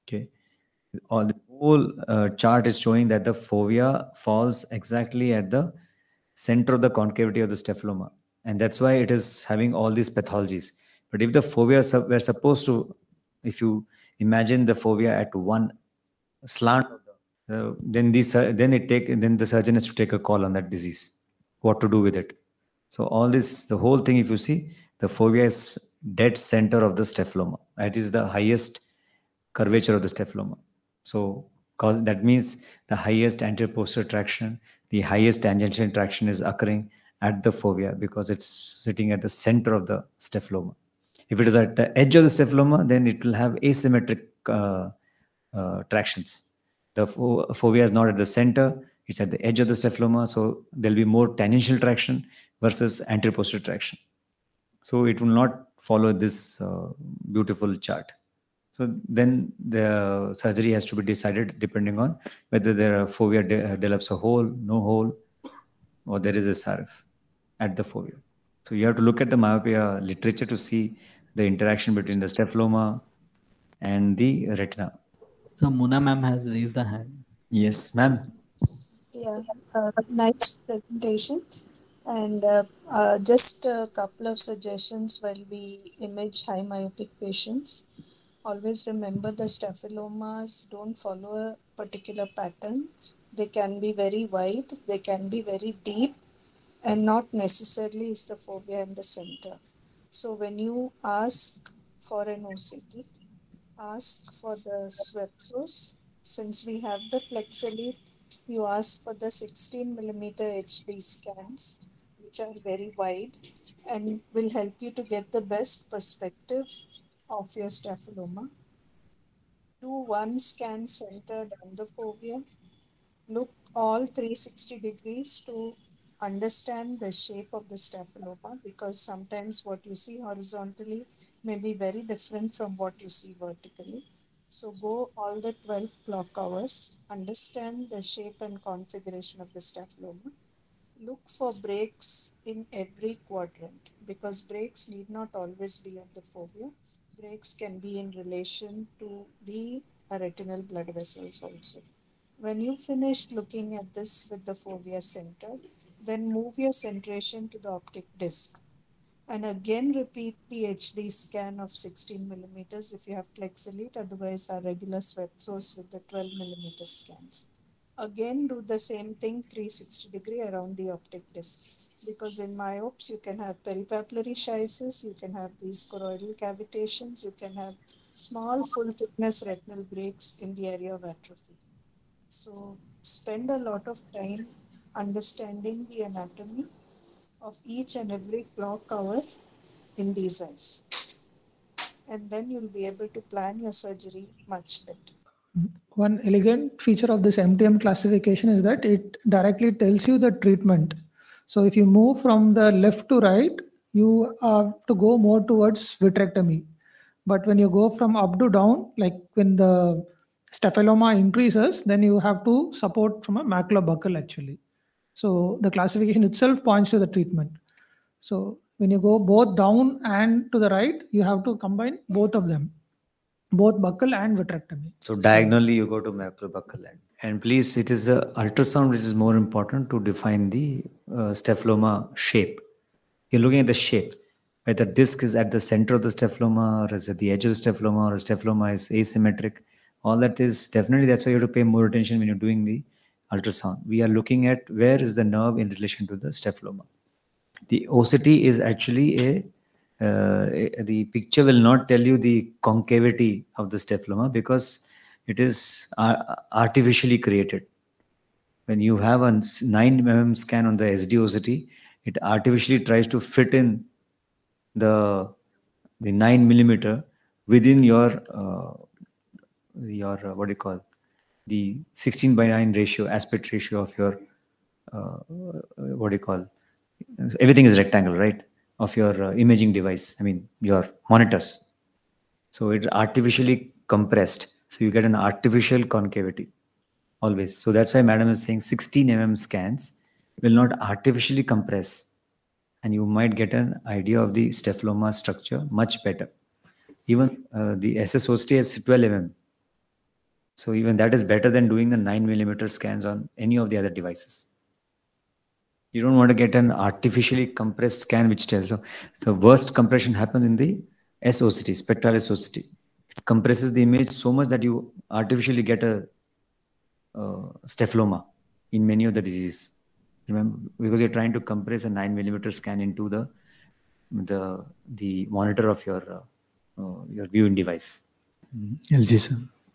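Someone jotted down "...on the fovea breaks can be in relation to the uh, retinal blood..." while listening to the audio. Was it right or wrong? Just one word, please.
right.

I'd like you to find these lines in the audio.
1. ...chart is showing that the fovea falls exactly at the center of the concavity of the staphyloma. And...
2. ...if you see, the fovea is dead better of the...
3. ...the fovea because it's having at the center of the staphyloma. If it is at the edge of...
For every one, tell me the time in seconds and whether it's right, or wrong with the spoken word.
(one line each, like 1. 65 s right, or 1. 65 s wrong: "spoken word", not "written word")
1. 2 s right
2. 24 s wrong: "center", not "better"
3. 37 s wrong: "sitting", not "having".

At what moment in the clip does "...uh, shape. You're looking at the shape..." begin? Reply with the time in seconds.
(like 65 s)
231 s.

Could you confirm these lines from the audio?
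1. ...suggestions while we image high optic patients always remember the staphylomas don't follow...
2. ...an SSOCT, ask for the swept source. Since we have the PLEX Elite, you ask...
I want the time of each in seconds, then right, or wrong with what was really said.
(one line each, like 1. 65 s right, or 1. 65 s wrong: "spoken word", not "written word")
1. 84 s wrong: "myopic", not "optic"
2. 102 s wrong: "OCT", not "SSOCT".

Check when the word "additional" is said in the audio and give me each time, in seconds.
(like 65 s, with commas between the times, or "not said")
not said.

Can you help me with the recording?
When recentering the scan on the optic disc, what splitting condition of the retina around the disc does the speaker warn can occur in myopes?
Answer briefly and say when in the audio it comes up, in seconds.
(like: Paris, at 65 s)
Peripapillary schisis, at 173 s.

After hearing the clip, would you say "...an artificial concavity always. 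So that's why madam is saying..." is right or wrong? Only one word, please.
right.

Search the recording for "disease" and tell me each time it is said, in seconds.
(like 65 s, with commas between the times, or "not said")
20 s, 319 s.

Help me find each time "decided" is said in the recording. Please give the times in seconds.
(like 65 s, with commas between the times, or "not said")
61 s.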